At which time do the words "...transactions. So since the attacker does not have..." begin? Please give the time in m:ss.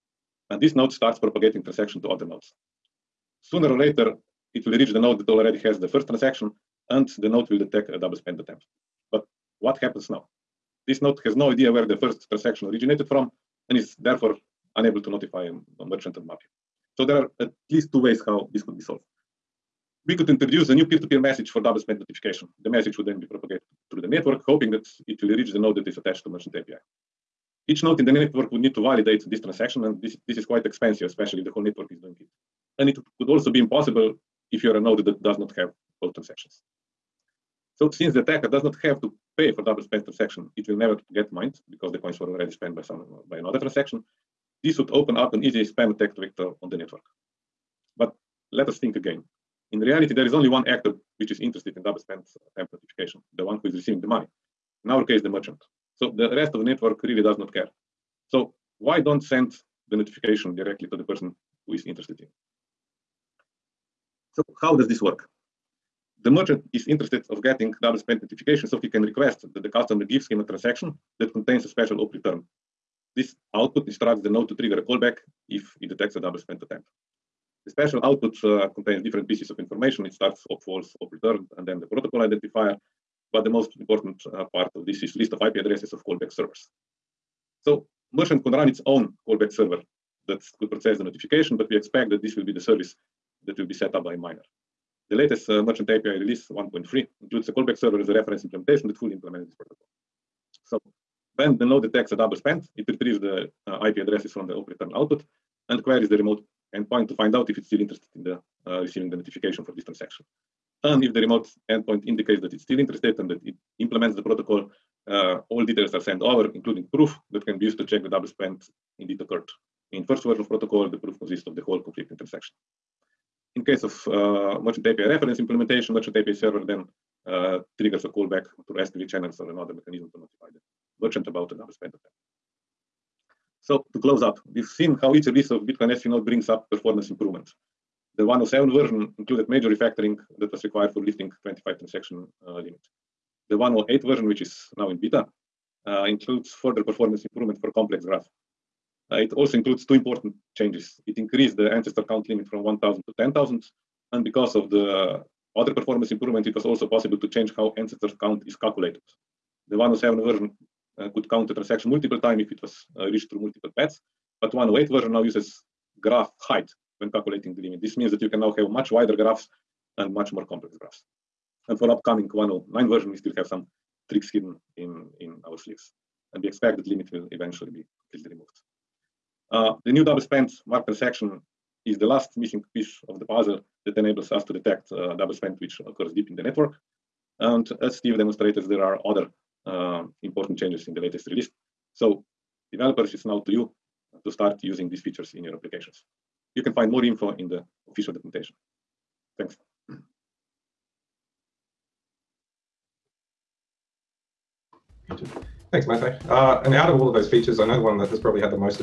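0:36.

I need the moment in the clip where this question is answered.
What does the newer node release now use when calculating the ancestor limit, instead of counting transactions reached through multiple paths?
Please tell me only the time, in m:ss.
2:46.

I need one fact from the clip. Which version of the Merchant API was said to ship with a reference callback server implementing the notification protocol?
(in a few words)
1.3.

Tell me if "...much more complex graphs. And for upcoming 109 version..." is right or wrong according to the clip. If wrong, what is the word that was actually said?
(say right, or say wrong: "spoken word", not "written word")
right.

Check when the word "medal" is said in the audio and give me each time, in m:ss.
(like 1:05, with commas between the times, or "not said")
not said.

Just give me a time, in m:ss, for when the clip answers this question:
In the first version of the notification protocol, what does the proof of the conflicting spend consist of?
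2:01.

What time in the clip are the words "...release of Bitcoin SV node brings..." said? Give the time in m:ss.
2:15.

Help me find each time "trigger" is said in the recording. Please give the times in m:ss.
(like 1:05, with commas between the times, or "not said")
1:14, 2:07.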